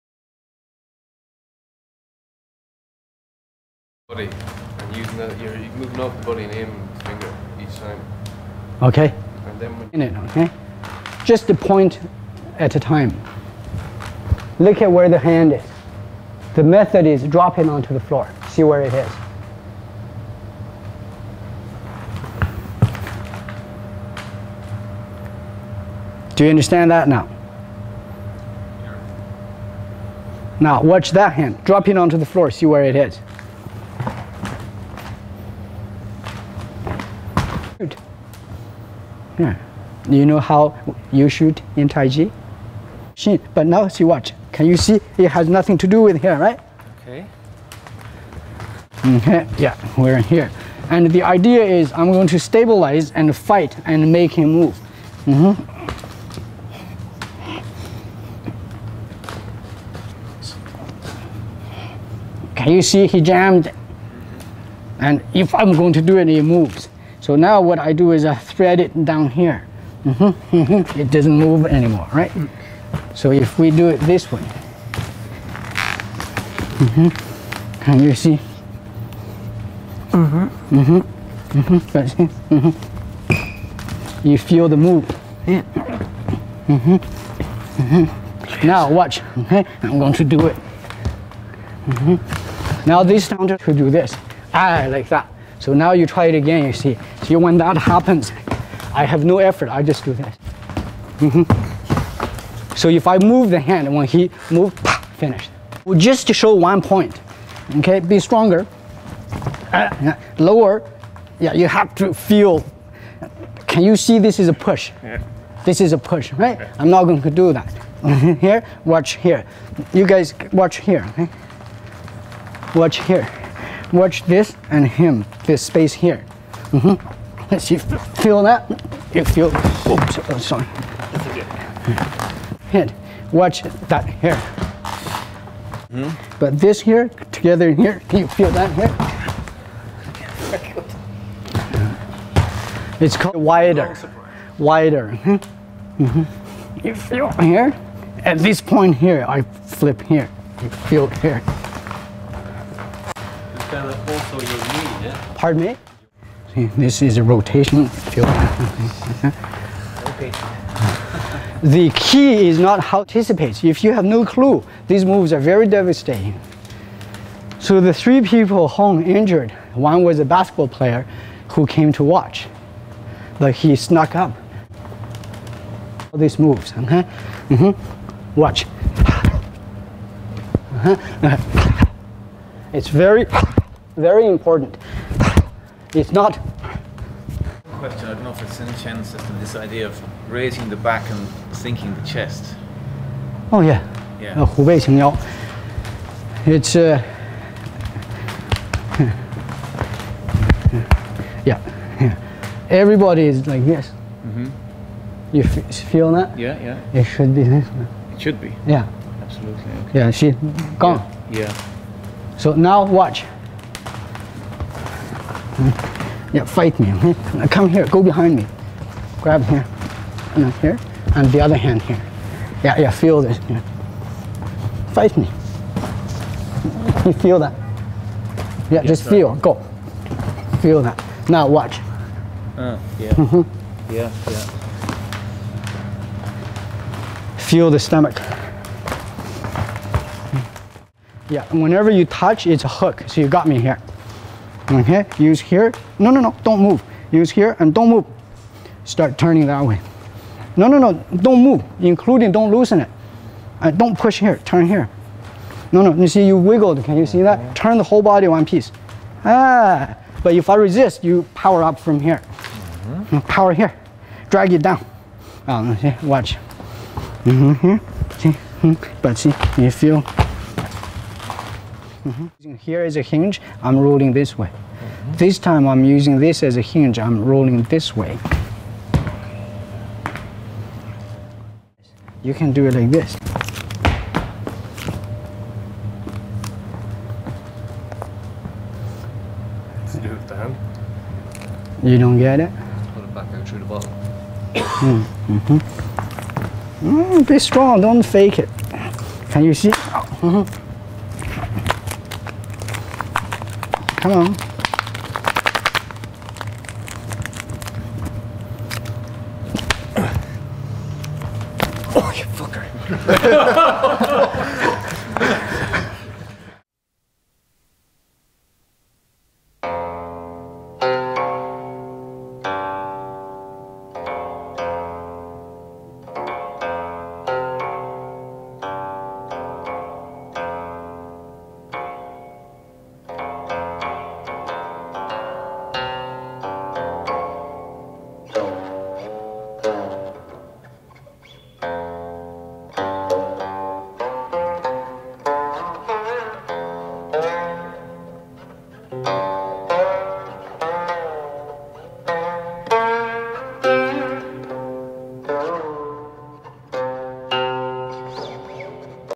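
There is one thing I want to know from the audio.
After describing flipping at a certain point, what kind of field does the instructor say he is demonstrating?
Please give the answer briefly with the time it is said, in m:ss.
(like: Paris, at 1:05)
Rotational, at 2:37.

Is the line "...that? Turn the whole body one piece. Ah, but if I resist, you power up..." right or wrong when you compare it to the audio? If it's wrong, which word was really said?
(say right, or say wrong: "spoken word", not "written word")
right.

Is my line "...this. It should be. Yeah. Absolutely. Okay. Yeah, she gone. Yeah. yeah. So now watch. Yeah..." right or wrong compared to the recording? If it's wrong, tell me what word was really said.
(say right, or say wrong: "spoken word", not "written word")
right.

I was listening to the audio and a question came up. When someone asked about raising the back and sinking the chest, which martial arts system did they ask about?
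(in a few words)
Chen system.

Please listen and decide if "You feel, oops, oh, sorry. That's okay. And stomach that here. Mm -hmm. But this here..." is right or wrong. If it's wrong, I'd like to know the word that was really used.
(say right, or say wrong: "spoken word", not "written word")
wrong: "watch", not "stomach".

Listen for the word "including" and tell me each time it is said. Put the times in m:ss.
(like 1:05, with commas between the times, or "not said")
4:11.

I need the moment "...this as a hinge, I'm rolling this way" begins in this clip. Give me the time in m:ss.
4:36.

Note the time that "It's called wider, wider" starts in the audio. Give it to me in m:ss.
2:22.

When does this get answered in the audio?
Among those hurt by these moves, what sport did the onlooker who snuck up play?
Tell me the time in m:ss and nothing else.
2:50.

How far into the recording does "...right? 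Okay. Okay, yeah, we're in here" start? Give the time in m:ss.
0:46.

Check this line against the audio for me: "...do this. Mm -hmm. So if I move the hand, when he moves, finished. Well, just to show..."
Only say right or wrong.
right.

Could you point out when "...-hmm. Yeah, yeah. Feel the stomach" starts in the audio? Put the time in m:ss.
3:53.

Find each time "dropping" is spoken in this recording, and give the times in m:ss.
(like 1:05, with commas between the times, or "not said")
0:17, 0:31.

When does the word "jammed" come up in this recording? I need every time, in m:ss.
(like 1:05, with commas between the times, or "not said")
1:03.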